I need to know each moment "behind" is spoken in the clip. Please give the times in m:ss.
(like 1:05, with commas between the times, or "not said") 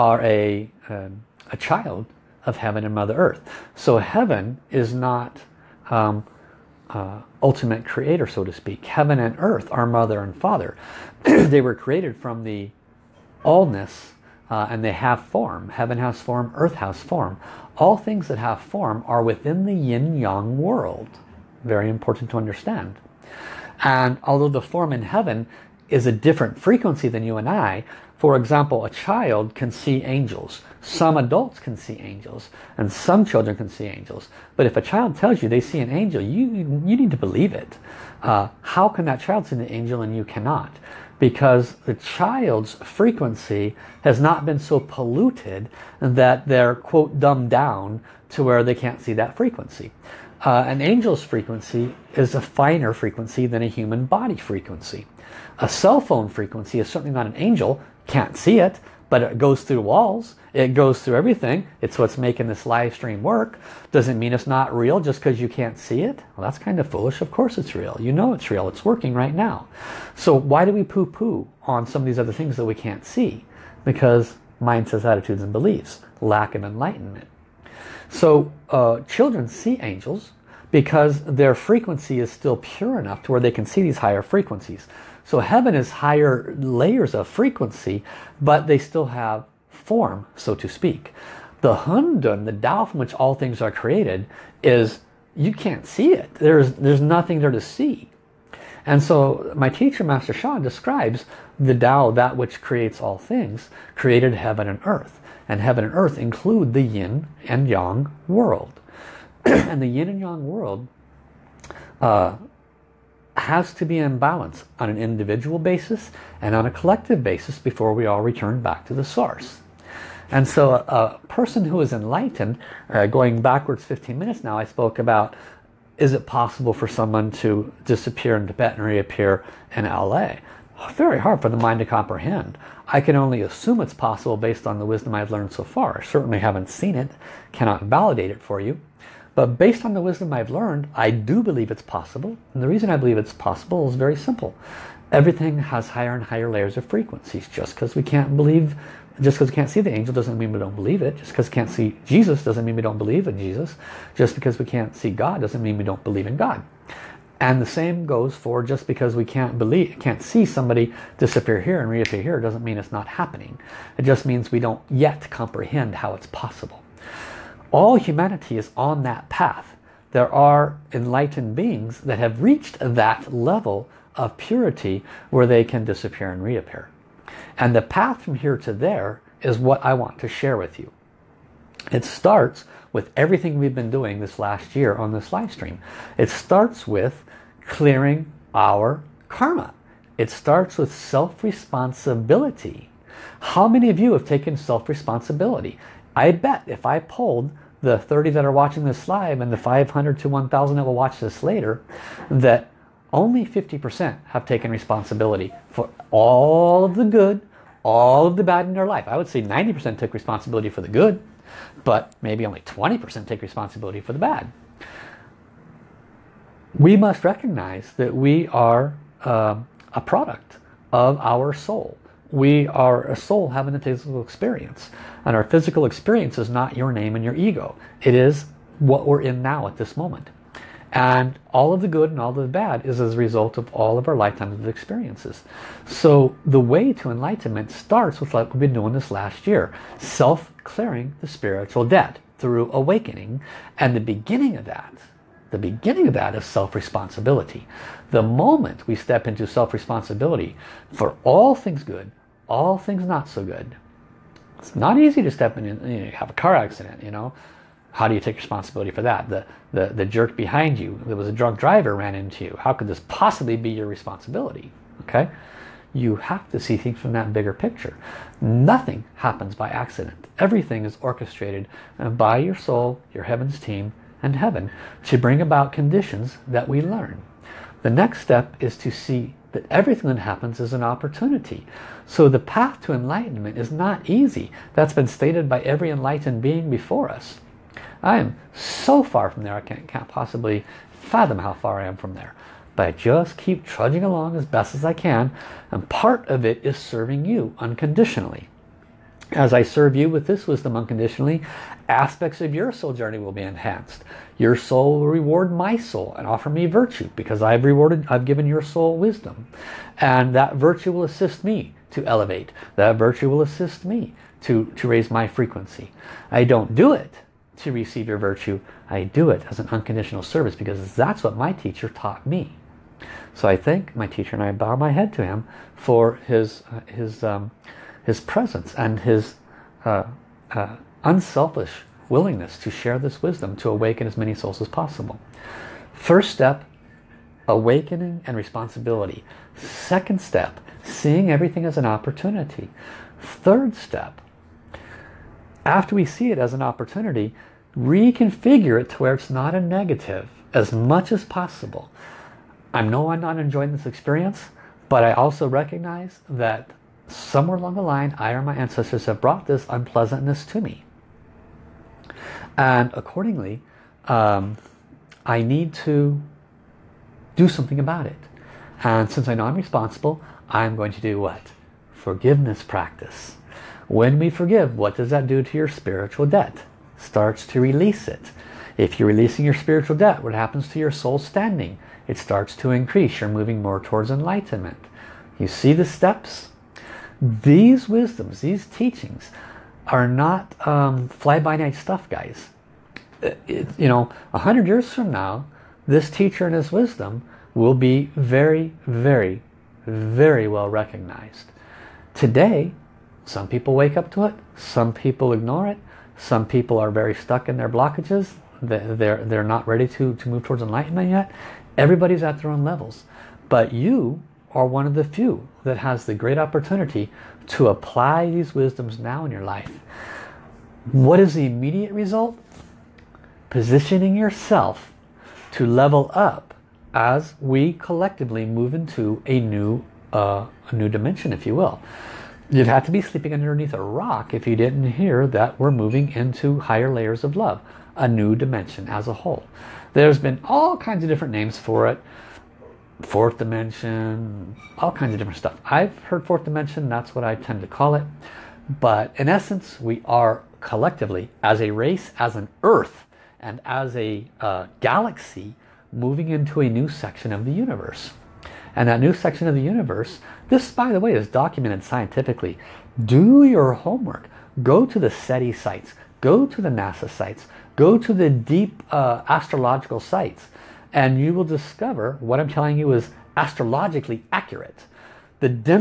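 4:20.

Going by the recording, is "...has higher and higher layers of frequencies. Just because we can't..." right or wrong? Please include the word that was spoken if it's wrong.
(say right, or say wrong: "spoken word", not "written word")
right.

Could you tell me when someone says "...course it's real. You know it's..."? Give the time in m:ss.
1:07.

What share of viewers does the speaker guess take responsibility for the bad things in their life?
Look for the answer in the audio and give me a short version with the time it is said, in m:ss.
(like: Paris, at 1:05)
20%, at 3:32.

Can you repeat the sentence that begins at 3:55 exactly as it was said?
So the way to enlightenment starts with like we've been doing this last year.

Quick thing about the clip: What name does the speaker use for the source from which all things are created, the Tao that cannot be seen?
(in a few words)
Hundun.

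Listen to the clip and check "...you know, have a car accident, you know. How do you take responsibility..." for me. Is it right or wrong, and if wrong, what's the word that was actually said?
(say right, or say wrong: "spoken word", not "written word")
right.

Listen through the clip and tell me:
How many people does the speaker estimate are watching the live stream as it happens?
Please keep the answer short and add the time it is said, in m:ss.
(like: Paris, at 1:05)
30, at 3:17.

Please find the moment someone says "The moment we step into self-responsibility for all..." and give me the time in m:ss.
4:08.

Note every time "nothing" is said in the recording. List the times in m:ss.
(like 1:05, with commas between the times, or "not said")
1:37, 4:28.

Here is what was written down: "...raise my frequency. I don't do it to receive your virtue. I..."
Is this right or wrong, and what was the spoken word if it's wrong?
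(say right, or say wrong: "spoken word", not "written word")
right.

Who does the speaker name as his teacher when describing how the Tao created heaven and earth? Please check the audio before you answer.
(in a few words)
Master Shah.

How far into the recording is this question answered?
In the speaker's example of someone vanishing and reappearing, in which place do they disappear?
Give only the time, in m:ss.
2:08.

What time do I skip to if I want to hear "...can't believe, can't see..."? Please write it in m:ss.
2:39.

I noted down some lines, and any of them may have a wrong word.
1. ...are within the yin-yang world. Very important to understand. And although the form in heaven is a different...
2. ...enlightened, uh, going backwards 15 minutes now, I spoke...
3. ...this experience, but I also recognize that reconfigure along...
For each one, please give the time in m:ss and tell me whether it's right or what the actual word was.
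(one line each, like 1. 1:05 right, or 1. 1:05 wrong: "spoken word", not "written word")
1. 0:19 right
2. 2:01 right
3. 5:53 wrong: "somewhere", not "reconfigure".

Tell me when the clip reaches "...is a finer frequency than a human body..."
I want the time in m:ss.
0:52.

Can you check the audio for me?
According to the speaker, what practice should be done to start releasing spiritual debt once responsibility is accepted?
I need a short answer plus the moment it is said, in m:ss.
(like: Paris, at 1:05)
Forgiveness practice, at 6:11.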